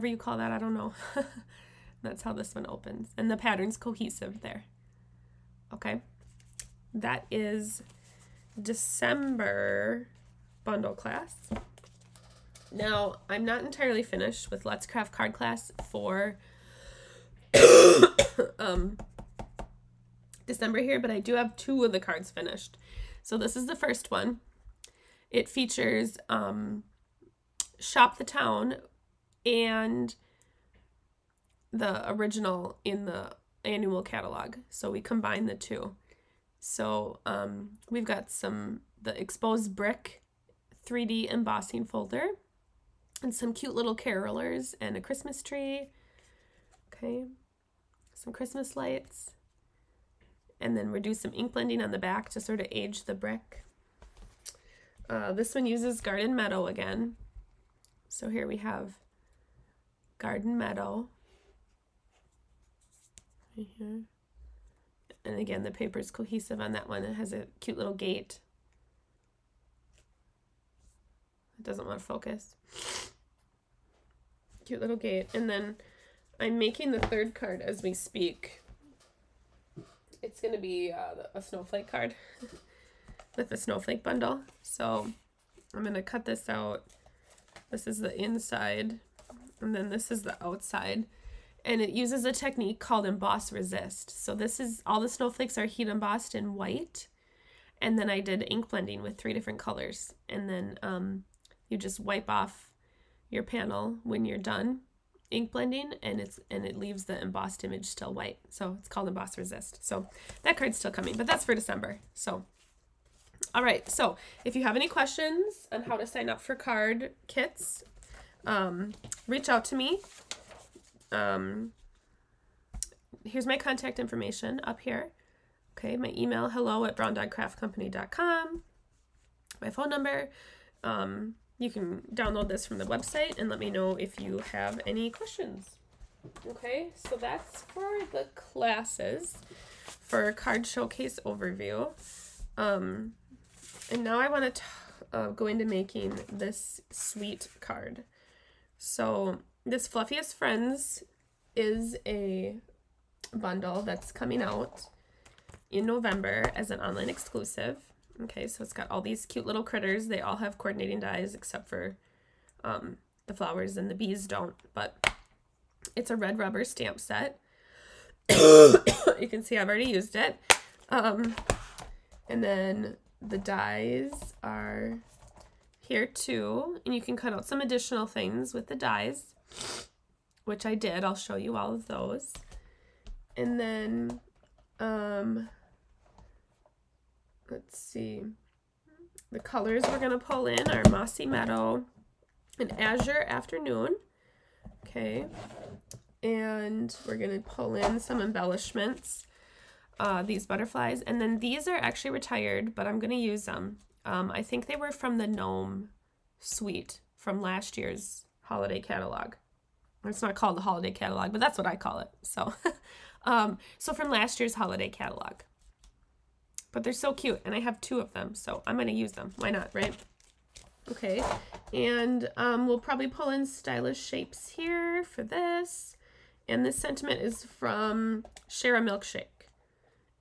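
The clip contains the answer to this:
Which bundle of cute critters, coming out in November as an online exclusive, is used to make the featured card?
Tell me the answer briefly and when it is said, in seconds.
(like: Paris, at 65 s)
Fluffiest Friends, at 149 s.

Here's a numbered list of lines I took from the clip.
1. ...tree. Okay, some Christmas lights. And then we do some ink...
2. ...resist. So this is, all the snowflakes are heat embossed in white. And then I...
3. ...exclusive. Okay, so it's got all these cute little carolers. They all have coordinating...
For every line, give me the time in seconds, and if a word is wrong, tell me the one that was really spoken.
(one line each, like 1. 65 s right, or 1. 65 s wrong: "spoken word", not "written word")
1. 45 s right
2. 93 s right
3. 157 s wrong: "critters", not "carolers".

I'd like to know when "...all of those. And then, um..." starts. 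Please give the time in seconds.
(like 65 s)
181 s.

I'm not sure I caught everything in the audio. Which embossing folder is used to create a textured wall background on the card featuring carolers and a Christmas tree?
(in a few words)
Exposed brick 3D.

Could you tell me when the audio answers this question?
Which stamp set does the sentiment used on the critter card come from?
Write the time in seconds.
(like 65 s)
228 s.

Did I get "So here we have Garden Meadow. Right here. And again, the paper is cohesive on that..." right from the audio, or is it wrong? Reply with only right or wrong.
right.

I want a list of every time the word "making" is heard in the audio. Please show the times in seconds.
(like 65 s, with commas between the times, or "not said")
76 s, 145 s.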